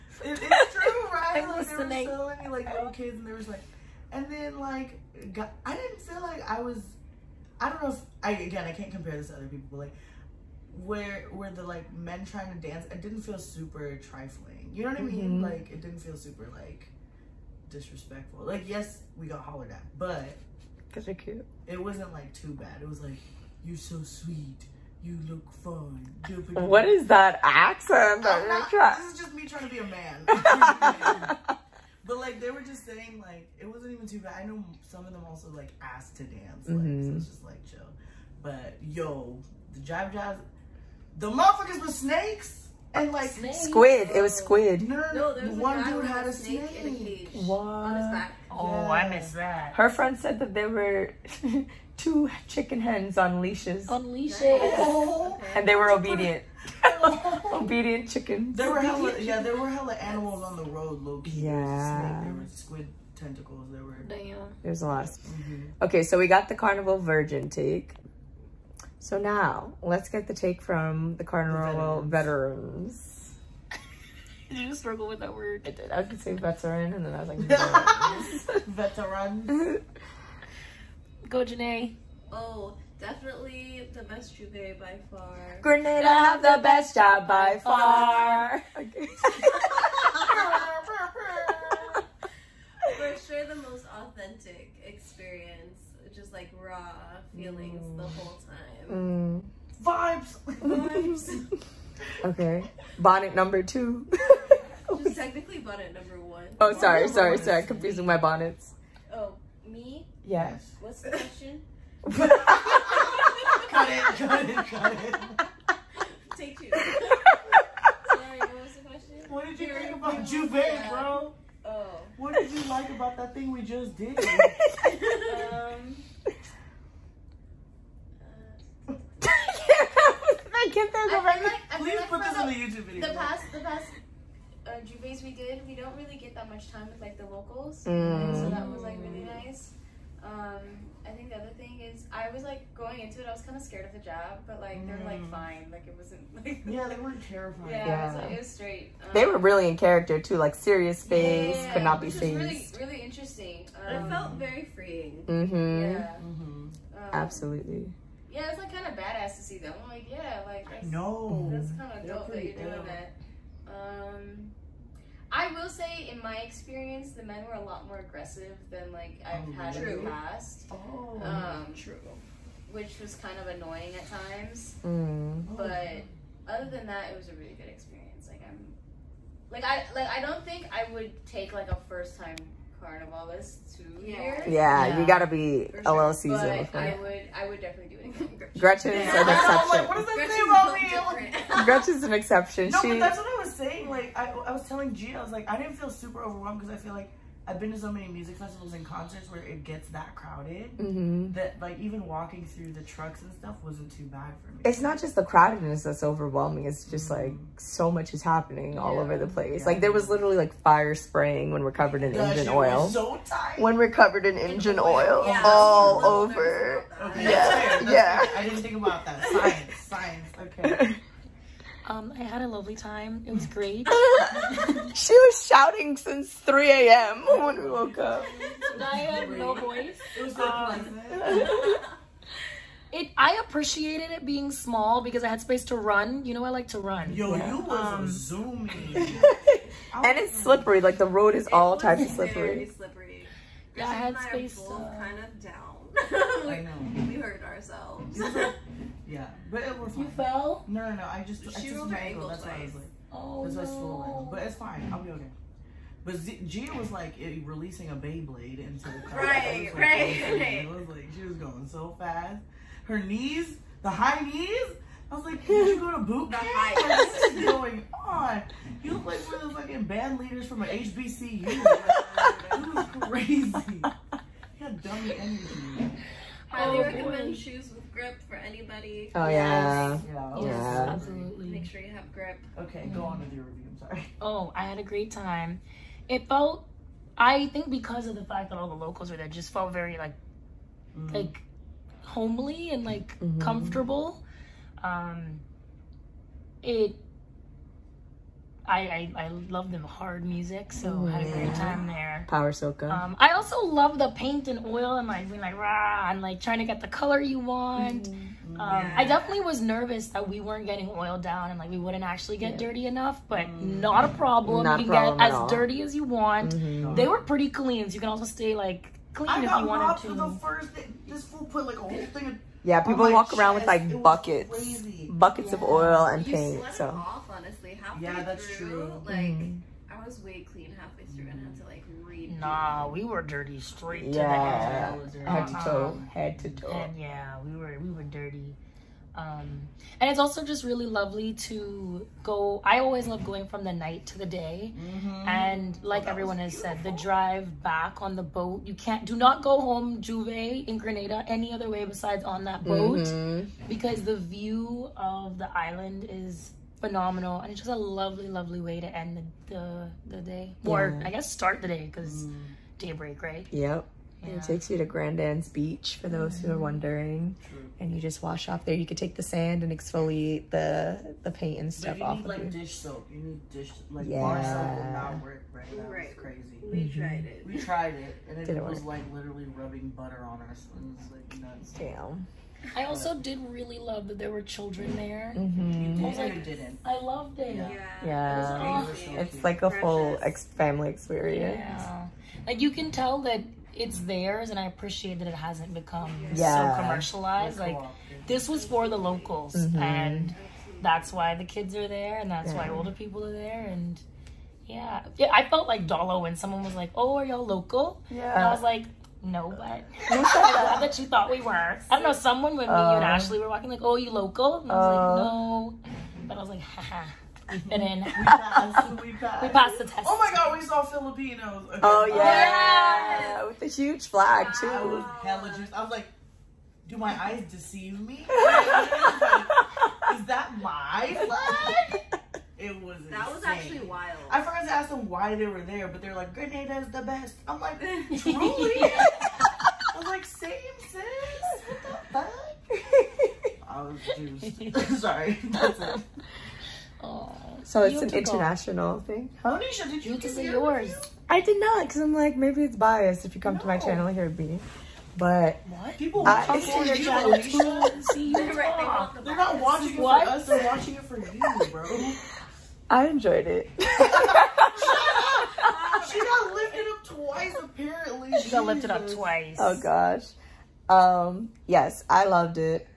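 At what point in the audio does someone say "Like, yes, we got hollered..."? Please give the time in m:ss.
0:18.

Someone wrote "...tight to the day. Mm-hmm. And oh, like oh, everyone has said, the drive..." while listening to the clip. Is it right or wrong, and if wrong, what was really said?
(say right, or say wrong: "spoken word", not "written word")
wrong: "night", not "tight".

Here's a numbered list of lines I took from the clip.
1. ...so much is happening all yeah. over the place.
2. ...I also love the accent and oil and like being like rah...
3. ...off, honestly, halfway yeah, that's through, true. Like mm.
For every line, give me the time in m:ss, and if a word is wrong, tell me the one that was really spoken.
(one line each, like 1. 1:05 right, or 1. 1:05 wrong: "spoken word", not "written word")
1. 3:27 right
2. 5:03 wrong: "paint", not "accent"
3. 5:26 right.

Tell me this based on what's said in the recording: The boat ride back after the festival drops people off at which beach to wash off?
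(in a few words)
Grand Anse Beach.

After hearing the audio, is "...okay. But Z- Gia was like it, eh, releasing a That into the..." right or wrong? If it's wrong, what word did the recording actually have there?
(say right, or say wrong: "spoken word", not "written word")
wrong: "Beyblade", not "That".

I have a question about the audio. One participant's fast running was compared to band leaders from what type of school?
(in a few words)
HBCU.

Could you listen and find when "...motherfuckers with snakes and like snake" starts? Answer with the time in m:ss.
0:41.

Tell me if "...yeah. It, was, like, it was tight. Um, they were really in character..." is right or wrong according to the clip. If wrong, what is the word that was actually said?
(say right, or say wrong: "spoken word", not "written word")
wrong: "straight", not "tight".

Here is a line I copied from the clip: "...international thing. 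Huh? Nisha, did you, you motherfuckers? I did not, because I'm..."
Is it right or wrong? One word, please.
wrong.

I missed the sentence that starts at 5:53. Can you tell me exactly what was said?
because the view of the island is phenomenal and it's just a lovely lovely way to end the the, the day yeah.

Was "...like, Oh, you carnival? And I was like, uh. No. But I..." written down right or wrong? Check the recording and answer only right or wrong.
wrong.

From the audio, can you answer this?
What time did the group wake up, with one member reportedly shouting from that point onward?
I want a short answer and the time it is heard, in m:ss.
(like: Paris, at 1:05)
3 a.m., at 3:46.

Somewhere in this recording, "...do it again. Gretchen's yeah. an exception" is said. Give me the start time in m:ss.
3:07.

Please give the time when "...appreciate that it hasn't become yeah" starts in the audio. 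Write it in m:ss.
6:34.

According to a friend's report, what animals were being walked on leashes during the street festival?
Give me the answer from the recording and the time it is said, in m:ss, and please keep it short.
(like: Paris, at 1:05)
Chicken hens, at 0:52.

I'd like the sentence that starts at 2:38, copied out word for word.
Yeah, it's like kind of badass to see them.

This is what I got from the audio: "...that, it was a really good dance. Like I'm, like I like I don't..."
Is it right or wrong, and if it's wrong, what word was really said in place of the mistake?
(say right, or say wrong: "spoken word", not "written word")
wrong: "experience", not "dance".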